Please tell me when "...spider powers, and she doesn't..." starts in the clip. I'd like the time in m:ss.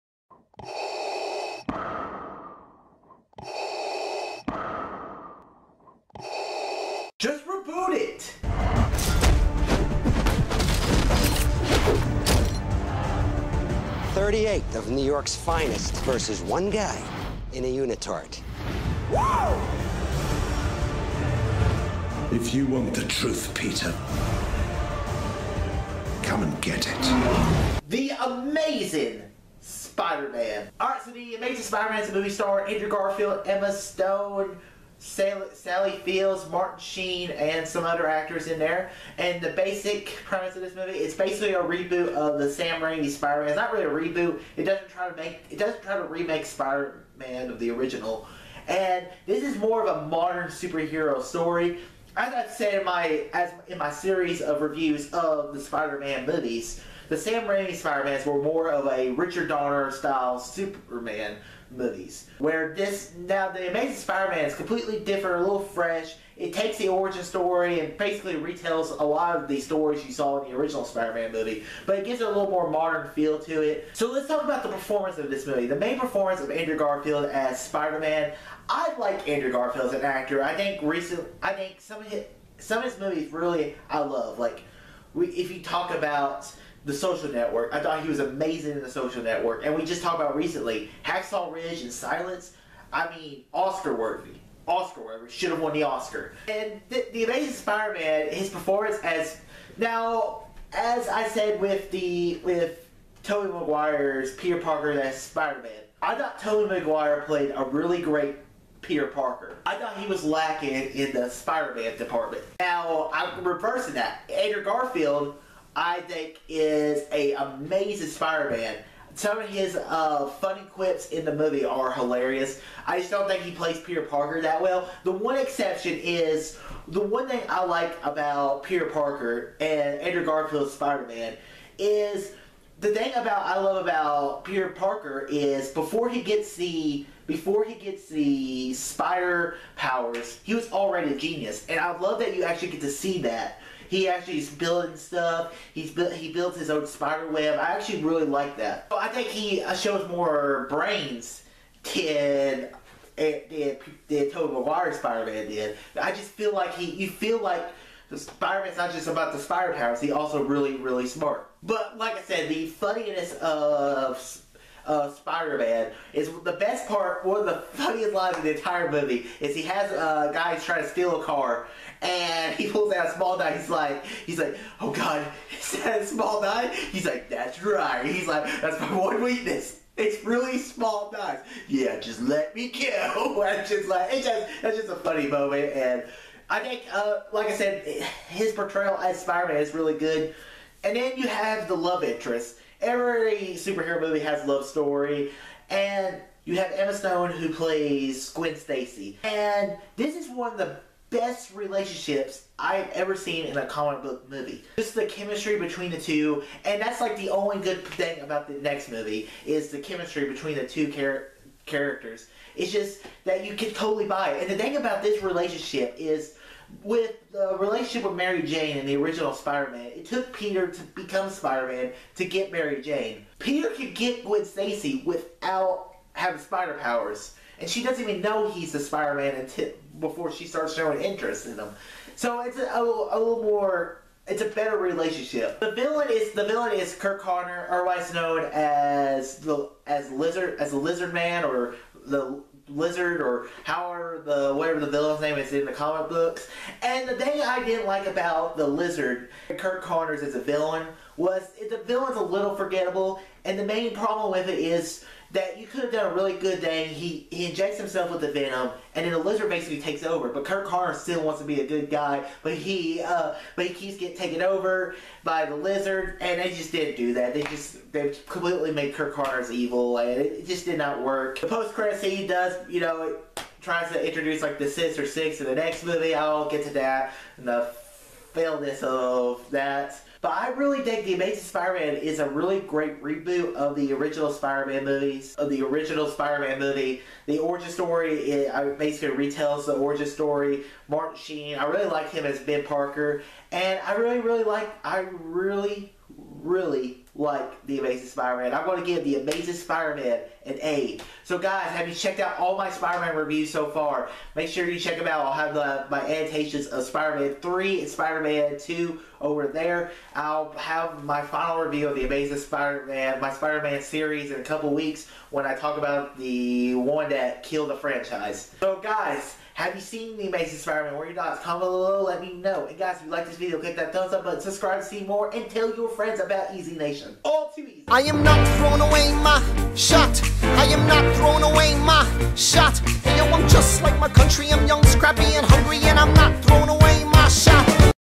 3:46.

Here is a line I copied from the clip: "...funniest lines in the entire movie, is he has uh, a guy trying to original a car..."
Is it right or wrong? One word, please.
wrong.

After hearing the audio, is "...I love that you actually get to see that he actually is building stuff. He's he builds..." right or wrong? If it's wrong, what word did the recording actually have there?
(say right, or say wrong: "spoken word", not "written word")
right.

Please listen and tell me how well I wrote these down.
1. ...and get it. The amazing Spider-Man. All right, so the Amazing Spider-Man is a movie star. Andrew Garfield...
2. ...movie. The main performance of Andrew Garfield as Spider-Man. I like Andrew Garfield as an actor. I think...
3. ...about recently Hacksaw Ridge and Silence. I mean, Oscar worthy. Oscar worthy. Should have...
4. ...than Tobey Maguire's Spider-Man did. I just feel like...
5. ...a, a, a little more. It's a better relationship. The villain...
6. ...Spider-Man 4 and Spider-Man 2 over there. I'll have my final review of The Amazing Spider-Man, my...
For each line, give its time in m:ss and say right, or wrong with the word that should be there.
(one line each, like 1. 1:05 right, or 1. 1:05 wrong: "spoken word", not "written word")
1. 0:26 right
2. 1:15 right
3. 1:30 right
4. 2:34 right
5. 3:52 right
6. 5:06 wrong: "3", not "4".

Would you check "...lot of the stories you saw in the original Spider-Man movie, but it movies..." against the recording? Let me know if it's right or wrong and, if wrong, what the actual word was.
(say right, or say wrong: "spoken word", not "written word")
wrong: "gives", not "movies".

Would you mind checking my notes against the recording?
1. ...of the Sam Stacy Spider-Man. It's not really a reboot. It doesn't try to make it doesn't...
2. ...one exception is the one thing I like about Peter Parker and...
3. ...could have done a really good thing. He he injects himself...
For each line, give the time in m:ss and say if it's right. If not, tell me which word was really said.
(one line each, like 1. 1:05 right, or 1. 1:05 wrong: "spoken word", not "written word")
1. 0:42 wrong: "Raimi", not "Stacy"
2. 2:05 right
3. 4:15 right.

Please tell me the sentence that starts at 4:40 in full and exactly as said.
But I really think The Amazing Spider-Man is a really great reboot of the original Spider-Man movies, of the original Spider-Man movie.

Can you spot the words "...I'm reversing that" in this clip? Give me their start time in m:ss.
1:53.